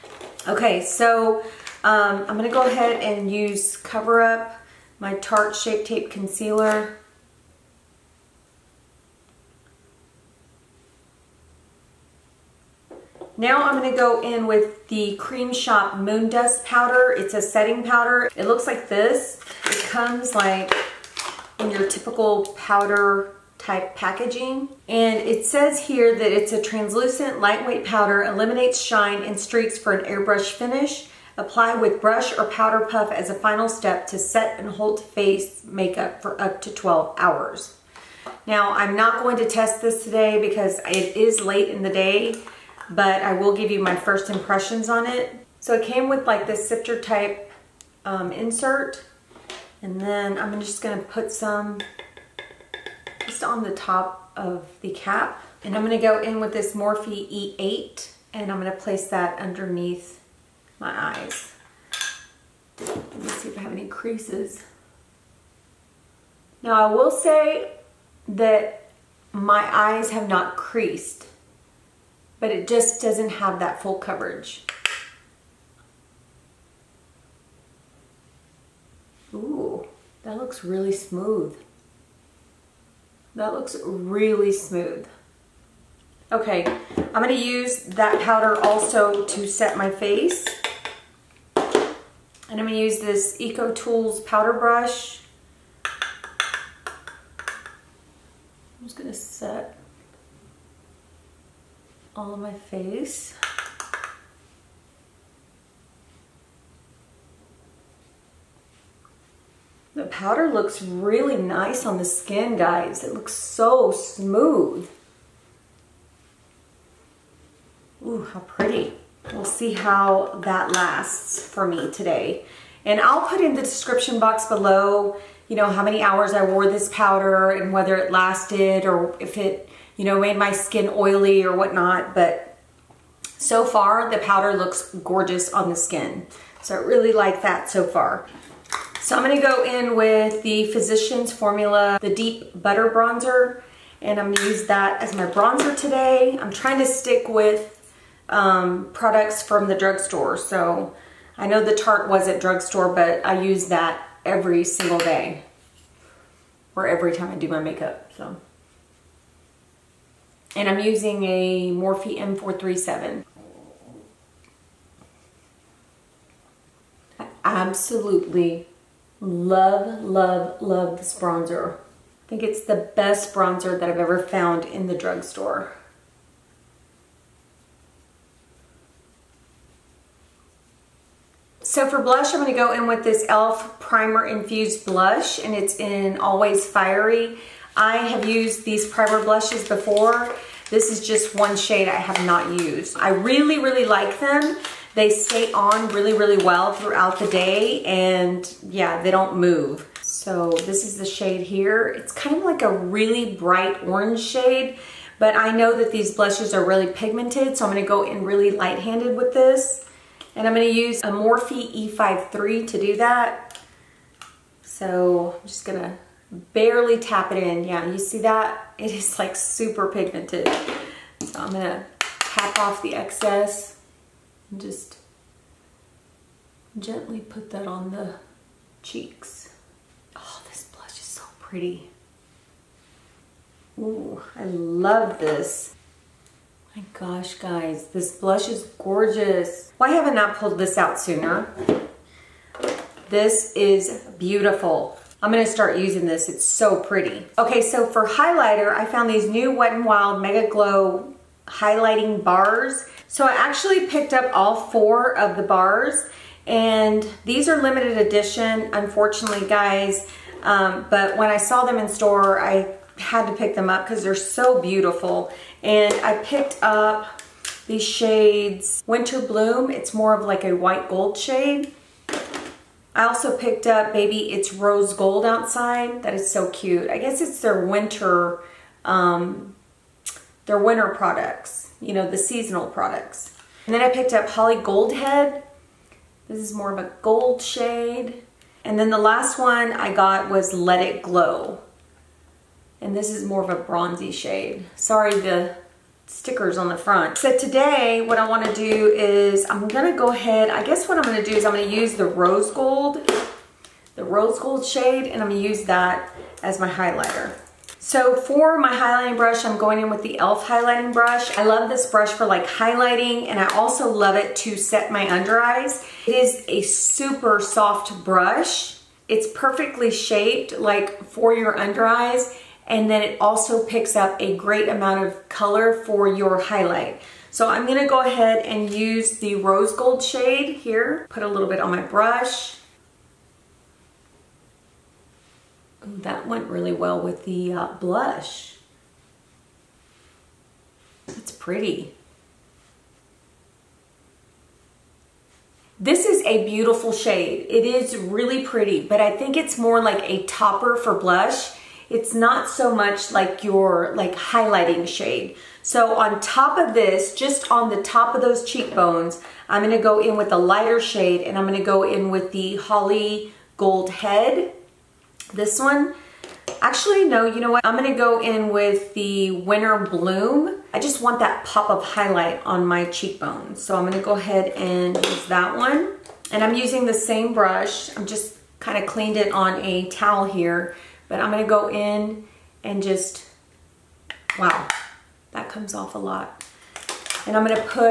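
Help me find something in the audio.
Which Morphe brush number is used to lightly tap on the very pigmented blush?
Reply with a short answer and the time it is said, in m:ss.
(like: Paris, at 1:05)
E53, at 3:31.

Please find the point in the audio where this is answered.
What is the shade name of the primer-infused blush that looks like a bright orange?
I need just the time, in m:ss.
3:06.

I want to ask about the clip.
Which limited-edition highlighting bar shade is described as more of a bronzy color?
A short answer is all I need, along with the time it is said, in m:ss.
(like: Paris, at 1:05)
Let It Glow, at 4:50.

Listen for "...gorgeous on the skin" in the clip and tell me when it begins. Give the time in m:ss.
2:15.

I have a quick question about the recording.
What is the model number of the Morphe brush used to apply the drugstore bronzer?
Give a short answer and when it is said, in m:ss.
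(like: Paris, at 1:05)
M437, at 2:42.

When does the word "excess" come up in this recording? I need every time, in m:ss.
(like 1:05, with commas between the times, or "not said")
3:42.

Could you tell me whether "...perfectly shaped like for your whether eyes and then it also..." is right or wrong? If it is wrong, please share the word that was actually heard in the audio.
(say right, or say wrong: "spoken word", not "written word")
wrong: "under", not "whether".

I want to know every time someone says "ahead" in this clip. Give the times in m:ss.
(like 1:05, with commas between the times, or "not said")
0:02, 5:00, 5:28, 6:14.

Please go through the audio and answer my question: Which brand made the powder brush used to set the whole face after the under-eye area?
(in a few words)
Eco Tools.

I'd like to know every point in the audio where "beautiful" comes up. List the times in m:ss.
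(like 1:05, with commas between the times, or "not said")
4:04, 4:24, 5:46.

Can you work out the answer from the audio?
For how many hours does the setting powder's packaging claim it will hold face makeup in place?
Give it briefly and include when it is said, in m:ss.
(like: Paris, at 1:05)
12, at 0:36.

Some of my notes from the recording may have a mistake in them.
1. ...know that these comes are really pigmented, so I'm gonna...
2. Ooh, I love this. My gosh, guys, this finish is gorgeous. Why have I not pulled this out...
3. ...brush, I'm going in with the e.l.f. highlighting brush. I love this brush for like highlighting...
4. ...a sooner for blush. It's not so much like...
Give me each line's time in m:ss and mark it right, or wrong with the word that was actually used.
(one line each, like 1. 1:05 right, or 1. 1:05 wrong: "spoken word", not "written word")
1. 3:25 wrong: "blushes", not "comes"
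2. 3:53 wrong: "blush", not "finish"
3. 5:09 right
4. 5:50 wrong: "topper", not "sooner".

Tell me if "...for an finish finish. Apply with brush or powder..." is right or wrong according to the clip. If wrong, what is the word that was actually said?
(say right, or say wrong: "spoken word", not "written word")
wrong: "airbrush", not "finish".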